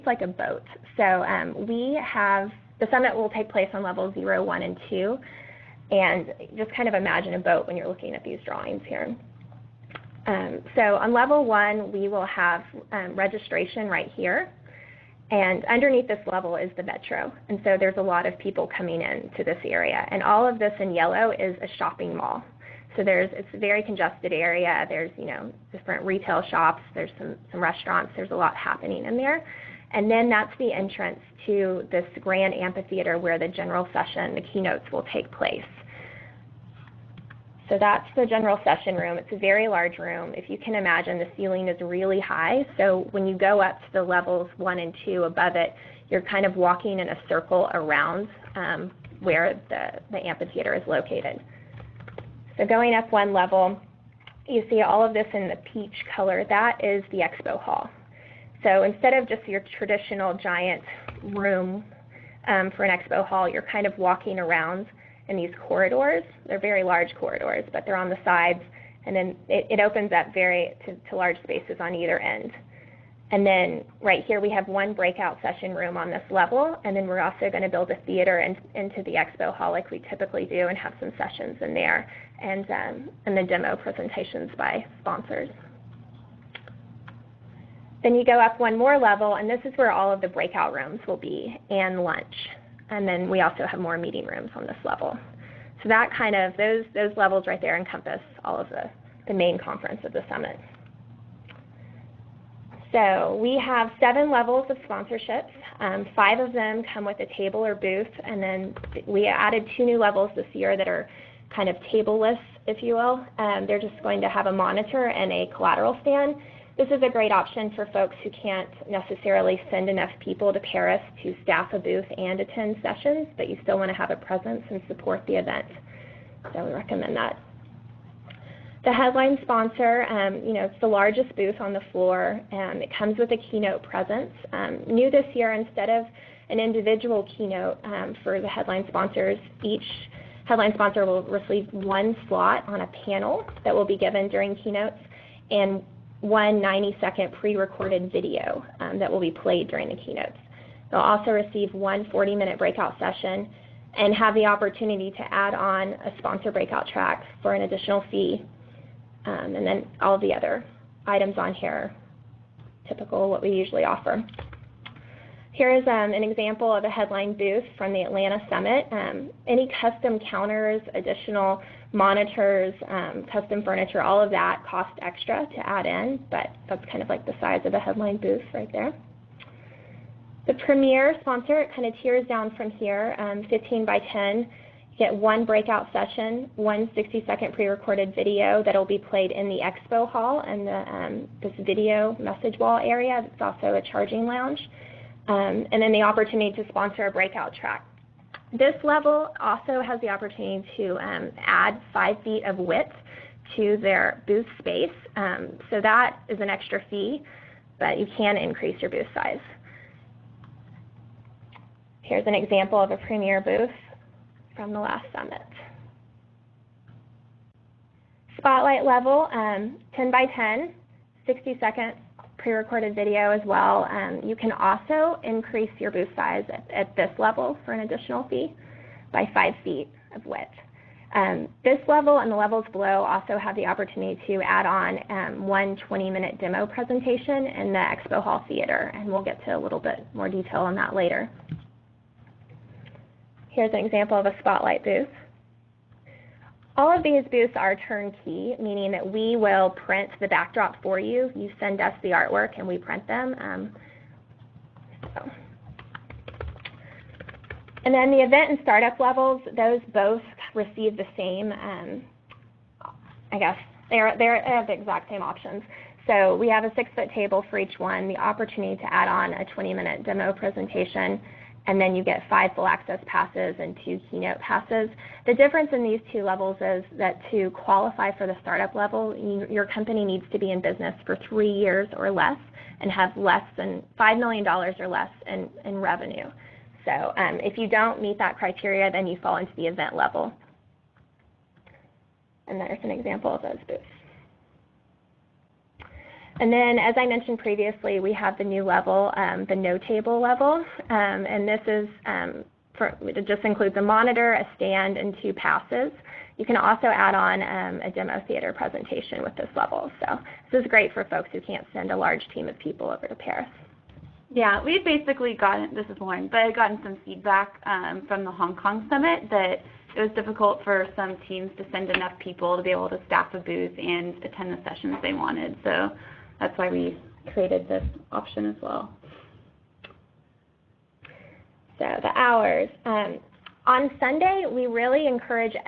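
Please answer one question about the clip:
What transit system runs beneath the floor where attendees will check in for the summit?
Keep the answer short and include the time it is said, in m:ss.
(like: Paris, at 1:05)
metro, at 0:16.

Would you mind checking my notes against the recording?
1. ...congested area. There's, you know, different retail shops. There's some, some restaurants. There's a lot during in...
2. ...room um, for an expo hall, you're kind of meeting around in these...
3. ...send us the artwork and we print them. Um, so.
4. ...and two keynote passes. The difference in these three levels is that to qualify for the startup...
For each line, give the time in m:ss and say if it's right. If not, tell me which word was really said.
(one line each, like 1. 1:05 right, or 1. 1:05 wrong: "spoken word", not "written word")
1. 0:23 wrong: "happening", not "during"
2. 1:01 wrong: "walking", not "meeting"
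3. 4:11 right
4. 4:33 wrong: "two", not "three".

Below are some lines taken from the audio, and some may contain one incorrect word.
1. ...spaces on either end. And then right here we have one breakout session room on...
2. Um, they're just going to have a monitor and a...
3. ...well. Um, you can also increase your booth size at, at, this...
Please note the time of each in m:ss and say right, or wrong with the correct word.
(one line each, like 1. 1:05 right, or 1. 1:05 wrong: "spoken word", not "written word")
1. 1:11 right
2. 1:53 right
3. 3:43 right.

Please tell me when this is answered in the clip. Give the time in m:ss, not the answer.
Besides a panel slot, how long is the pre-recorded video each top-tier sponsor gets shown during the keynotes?
2:26.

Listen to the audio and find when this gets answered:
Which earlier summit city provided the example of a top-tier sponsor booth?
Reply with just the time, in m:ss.
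2:48.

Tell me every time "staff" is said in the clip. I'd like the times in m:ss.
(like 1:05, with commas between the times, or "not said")
2:01, 5:23.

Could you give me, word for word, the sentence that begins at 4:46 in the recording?
So um, if you don't meet that criteria, then you fall into the event level.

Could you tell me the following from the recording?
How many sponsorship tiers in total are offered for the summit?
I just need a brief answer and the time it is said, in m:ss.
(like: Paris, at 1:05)
7, at 1:44.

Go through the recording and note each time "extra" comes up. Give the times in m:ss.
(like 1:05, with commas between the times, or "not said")
2:55, 3:26.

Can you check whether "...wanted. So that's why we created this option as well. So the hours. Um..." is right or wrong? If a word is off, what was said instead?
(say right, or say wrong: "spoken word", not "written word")
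right.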